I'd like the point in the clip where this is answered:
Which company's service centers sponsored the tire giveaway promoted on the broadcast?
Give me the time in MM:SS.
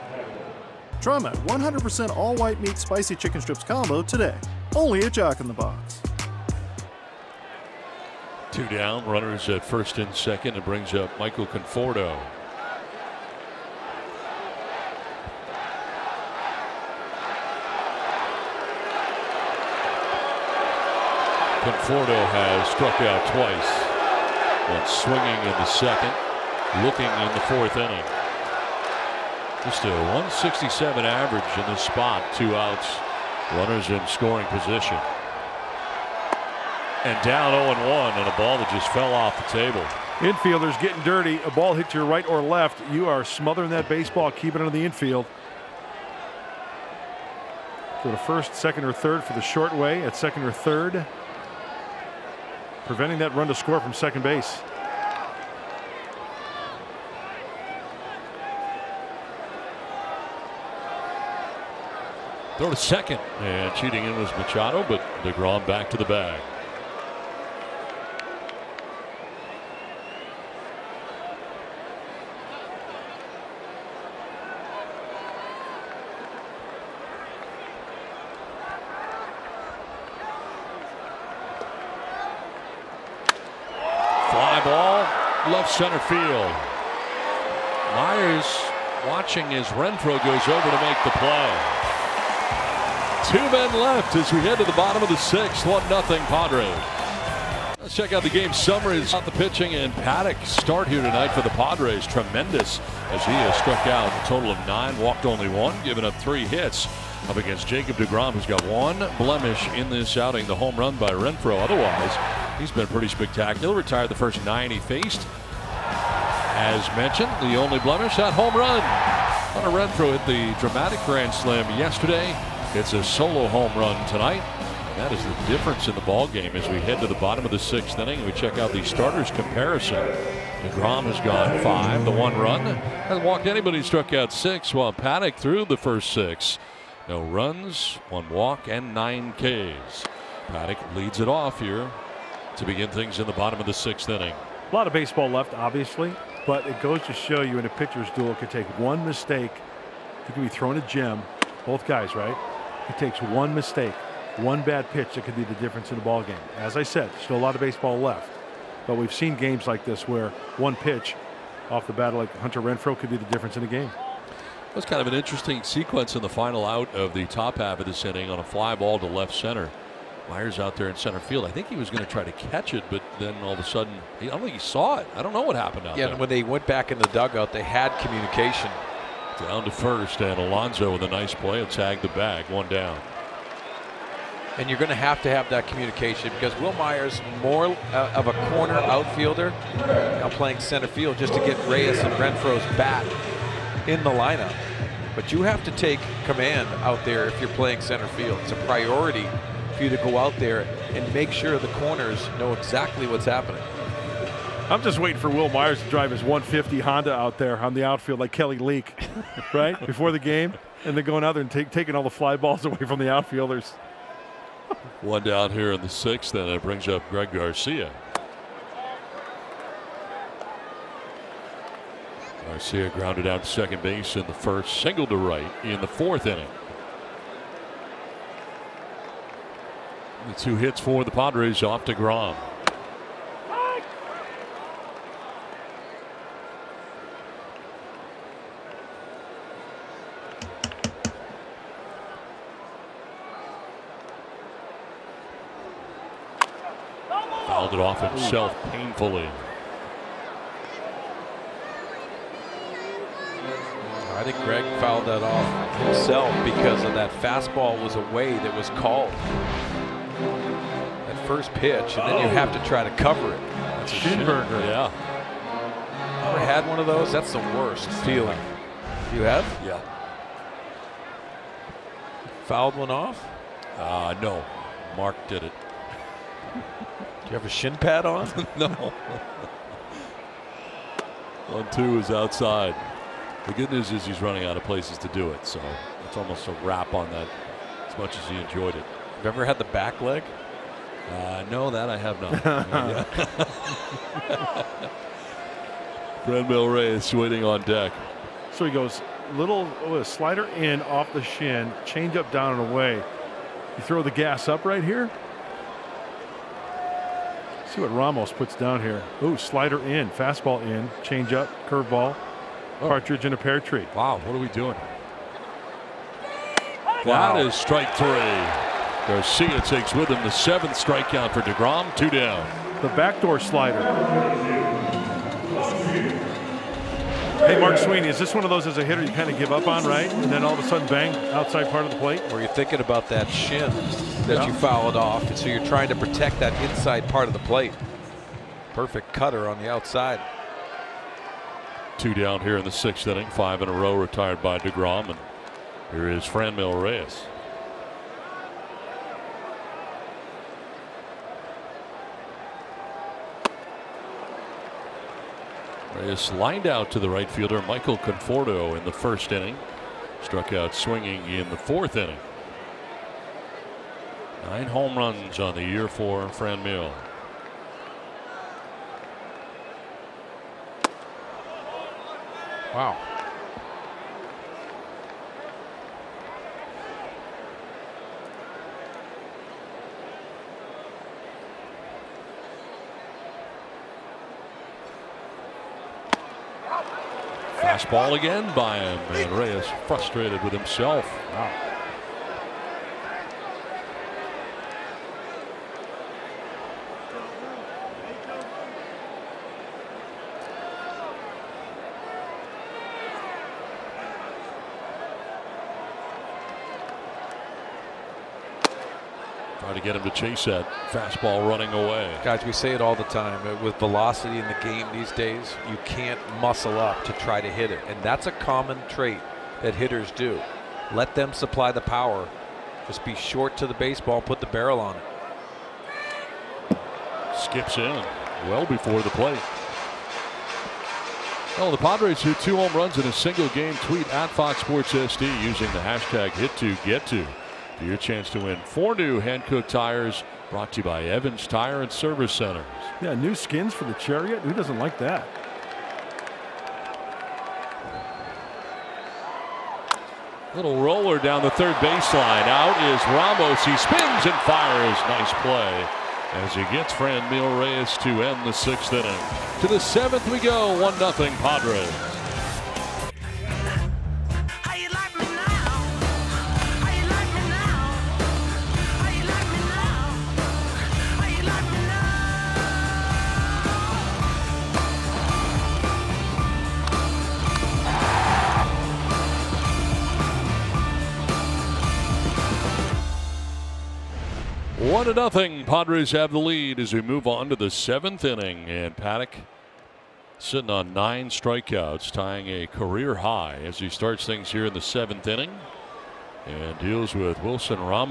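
07:21.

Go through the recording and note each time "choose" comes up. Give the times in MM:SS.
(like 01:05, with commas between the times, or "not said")
not said.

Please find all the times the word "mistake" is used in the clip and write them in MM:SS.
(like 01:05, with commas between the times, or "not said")
02:29, 02:33.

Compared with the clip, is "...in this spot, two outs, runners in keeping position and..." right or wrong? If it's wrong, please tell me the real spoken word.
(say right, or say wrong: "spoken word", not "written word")
wrong: "scoring", not "keeping".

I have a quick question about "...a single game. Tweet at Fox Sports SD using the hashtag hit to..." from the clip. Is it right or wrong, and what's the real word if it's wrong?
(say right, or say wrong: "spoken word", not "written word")
right.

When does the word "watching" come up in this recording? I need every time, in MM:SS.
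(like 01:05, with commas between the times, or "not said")
01:29.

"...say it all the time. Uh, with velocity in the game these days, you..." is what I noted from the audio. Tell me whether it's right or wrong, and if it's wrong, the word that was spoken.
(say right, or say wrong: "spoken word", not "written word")
right.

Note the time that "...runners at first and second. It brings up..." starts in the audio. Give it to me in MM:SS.
00:09.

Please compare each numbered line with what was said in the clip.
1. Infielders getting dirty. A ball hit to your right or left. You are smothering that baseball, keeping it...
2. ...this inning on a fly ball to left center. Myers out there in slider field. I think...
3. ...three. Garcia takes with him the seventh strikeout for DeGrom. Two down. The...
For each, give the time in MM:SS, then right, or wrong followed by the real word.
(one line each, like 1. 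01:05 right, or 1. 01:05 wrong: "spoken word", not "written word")
1. 00:40 right
2. 02:47 wrong: "center", not "slider"
3. 05:17 right.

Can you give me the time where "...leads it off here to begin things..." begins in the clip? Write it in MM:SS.
02:20.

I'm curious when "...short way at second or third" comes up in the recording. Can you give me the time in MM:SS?
00:49.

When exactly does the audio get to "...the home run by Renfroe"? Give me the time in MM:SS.
01:50.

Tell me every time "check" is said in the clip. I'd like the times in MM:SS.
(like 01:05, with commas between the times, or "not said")
01:37, 02:08.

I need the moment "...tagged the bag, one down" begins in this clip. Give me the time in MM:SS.
03:01.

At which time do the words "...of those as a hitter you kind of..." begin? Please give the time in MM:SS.
05:28.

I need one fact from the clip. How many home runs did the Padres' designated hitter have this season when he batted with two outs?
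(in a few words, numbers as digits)
9.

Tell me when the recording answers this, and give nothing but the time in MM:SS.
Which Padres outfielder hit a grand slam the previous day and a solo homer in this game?
02:42.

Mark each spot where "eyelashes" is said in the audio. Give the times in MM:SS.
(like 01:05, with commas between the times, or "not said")
not said.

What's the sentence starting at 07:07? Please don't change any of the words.
Skips in well before the plate.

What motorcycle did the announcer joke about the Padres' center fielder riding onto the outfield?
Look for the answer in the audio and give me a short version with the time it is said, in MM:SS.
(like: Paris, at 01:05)
150 Honda, at 03:26.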